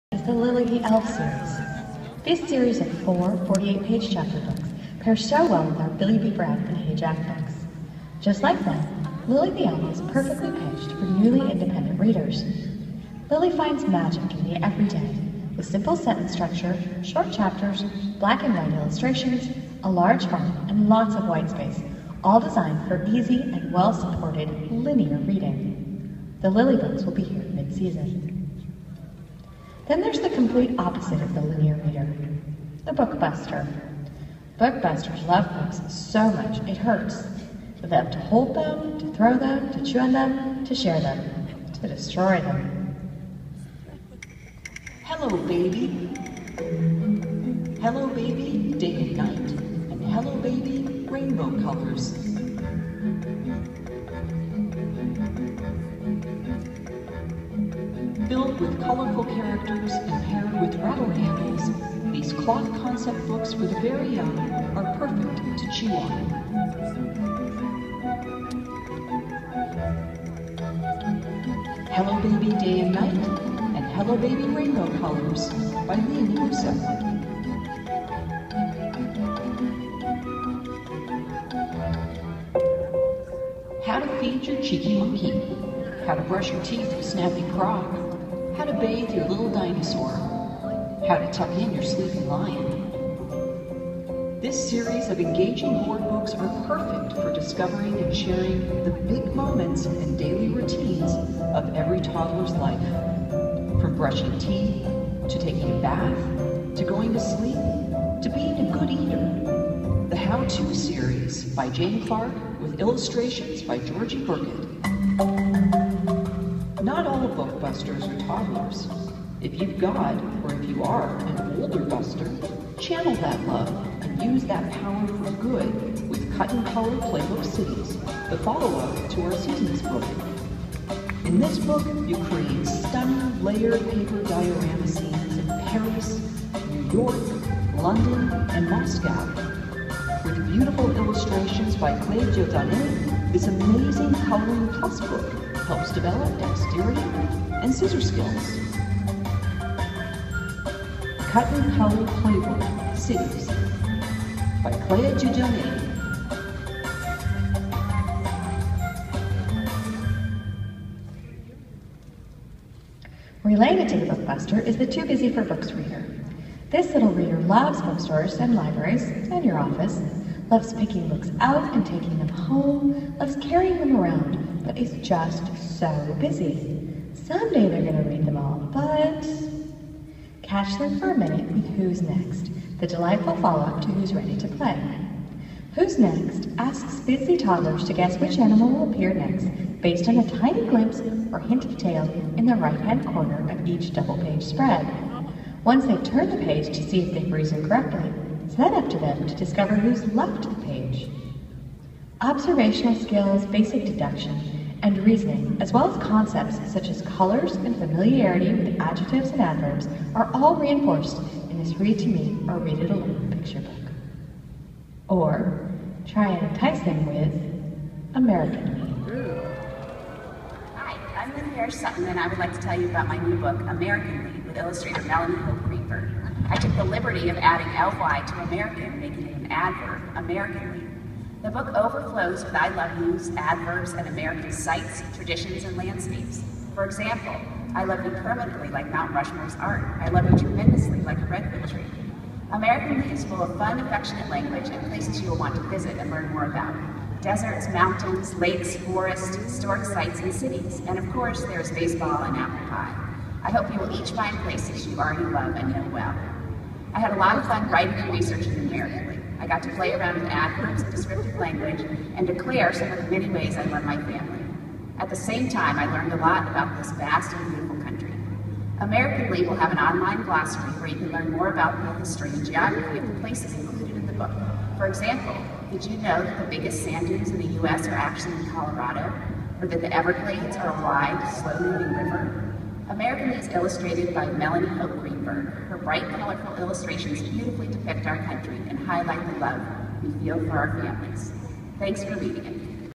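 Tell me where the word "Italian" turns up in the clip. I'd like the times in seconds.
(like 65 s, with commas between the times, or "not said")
not said.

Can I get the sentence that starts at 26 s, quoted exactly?
The Lily books will be here mid-season.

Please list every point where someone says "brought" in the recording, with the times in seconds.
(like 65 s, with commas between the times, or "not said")
not said.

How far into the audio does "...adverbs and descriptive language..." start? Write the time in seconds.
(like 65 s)
260 s.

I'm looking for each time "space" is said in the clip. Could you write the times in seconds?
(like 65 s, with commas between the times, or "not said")
21 s.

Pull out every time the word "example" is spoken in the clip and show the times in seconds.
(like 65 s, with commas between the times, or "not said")
236 s, 274 s.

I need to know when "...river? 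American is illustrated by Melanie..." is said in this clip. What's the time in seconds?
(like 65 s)
281 s.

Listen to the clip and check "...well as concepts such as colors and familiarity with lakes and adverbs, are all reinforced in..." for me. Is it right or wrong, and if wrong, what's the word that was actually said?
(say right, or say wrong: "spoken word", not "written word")
wrong: "adjectives", not "lakes".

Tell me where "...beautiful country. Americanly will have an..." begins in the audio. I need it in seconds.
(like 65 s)
267 s.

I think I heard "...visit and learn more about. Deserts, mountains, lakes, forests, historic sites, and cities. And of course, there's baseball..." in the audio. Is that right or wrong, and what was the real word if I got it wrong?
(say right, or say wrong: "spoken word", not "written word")
right.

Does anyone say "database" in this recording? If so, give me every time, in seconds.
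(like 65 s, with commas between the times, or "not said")
not said.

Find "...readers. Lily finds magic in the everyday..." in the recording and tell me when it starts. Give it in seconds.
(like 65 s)
11 s.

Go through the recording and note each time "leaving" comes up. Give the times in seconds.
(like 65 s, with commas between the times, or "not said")
not said.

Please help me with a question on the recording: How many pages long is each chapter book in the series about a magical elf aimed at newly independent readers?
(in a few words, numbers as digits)
48.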